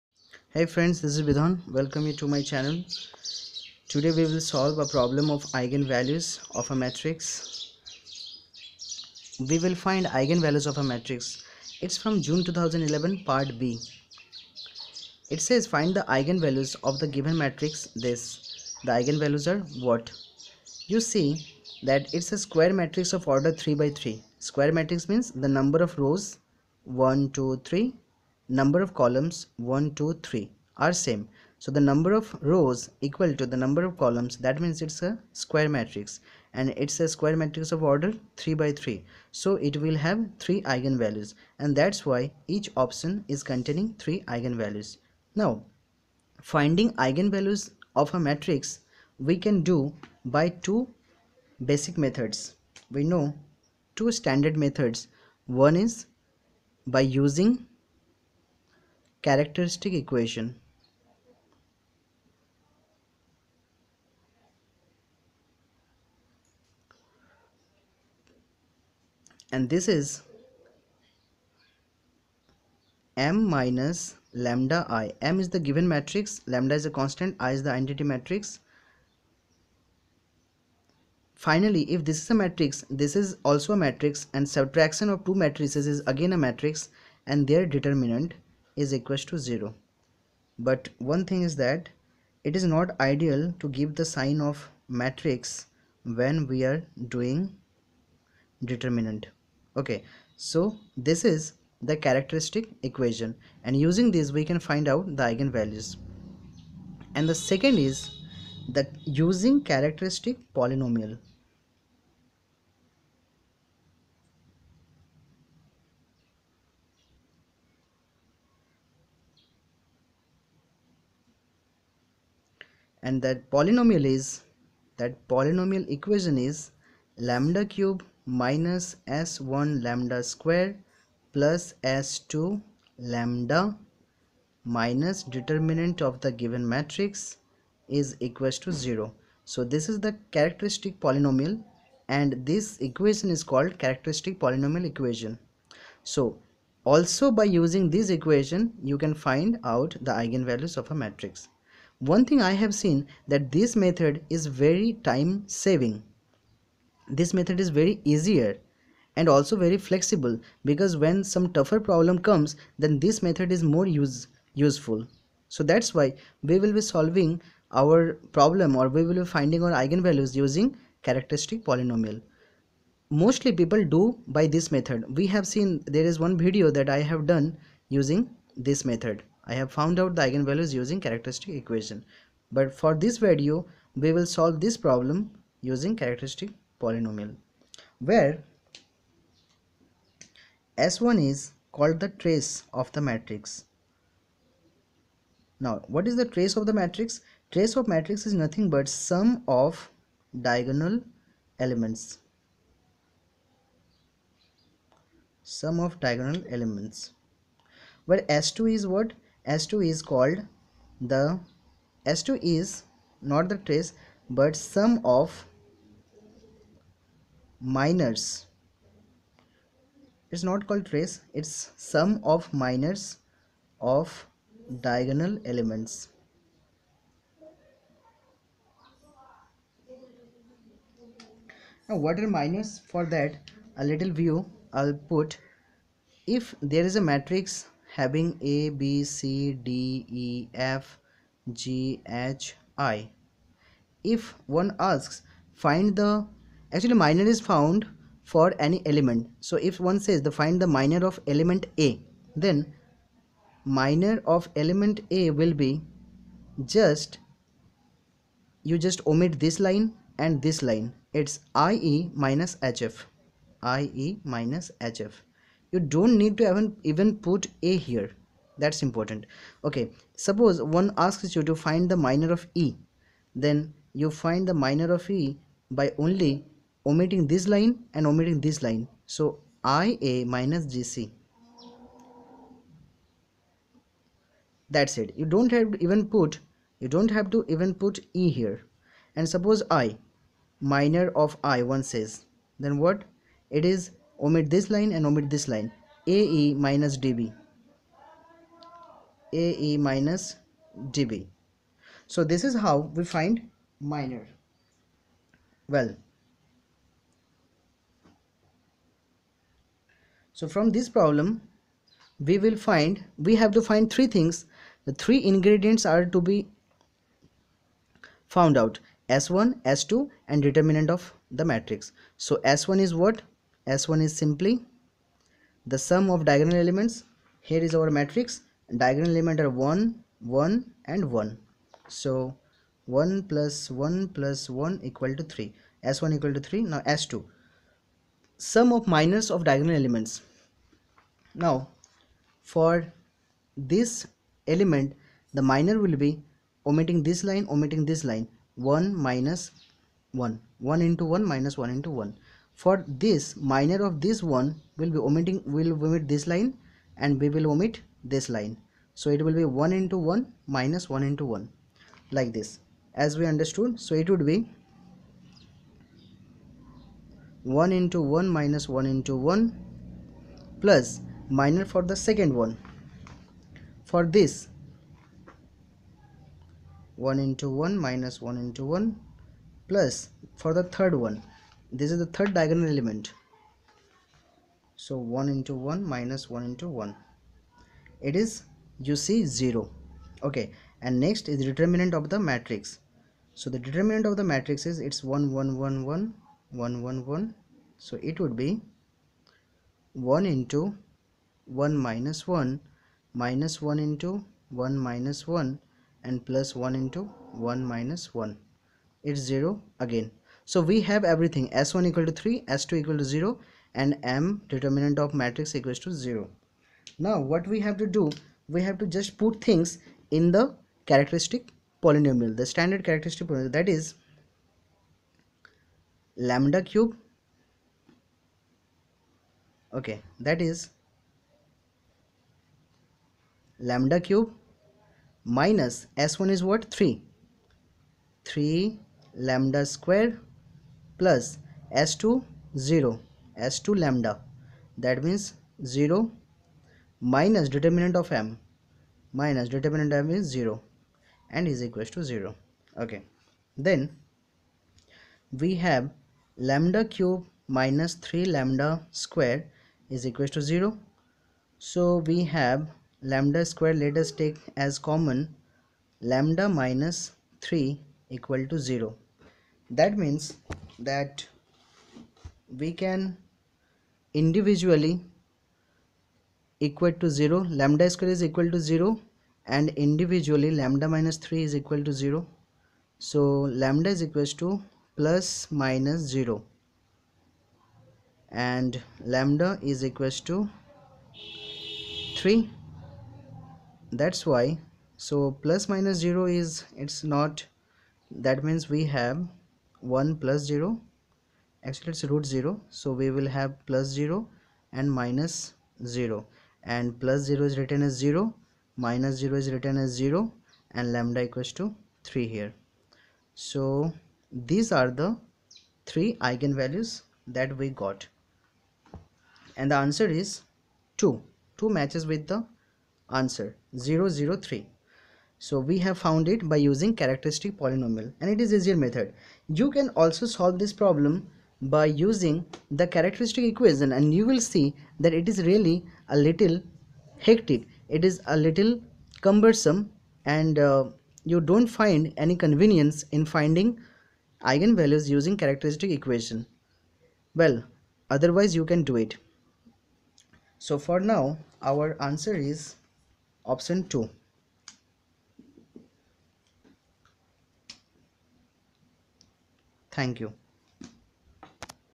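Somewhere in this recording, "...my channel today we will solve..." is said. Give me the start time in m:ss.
0:02.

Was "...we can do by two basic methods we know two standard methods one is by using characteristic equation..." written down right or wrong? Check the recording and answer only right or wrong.
right.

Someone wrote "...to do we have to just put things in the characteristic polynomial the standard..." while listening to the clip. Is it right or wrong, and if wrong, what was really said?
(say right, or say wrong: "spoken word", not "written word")
right.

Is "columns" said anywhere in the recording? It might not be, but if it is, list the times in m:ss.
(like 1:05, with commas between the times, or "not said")
0:28, 0:33.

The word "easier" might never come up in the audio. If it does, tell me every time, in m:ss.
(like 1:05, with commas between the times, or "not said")
2:38, 8:48.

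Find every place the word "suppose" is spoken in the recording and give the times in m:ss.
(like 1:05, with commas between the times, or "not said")
4:30, 4:49.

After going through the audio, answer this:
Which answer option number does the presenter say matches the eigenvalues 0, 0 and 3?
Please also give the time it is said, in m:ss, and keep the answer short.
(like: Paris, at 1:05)
2, at 9:13.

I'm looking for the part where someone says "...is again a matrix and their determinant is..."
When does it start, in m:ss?
1:25.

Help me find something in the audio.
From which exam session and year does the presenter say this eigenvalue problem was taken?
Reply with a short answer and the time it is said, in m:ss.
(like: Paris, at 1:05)
June 2011, at 0:12.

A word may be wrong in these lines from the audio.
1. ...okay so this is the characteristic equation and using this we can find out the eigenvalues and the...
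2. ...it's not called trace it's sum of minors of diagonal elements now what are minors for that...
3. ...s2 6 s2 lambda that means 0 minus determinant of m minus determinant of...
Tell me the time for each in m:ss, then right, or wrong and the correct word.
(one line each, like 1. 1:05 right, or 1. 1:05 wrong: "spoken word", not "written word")
1. 1:39 right
2. 3:40 right
3. 7:21 wrong: "0", not "6".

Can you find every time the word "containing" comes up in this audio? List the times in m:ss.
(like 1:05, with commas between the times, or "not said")
0:43.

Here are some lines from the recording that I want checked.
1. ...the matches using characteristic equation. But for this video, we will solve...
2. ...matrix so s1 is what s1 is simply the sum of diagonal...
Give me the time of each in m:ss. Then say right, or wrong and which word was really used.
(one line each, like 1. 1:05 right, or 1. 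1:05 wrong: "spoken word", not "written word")
1. 3:00 wrong: "eigenvalues", not "matches"
2. 5:21 right.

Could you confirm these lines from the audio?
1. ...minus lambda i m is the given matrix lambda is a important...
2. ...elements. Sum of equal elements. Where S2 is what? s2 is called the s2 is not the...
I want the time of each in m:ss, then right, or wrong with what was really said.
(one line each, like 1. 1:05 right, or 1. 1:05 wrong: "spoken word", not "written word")
1. 1:13 wrong: "constant", not "important"
2. 3:21 wrong: "diagonal", not "equal".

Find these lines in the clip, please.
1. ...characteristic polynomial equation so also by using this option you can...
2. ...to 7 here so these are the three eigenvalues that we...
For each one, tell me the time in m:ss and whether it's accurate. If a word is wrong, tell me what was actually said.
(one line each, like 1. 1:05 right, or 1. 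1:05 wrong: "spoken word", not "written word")
1. 2:23 wrong: "equation", not "option"
2. 8:31 wrong: "3", not "7".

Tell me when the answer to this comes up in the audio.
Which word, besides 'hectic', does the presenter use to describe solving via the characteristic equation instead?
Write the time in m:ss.
8:59.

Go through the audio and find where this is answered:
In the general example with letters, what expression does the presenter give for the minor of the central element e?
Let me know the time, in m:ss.
4:39.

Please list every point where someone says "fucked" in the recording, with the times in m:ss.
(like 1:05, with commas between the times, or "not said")
not said.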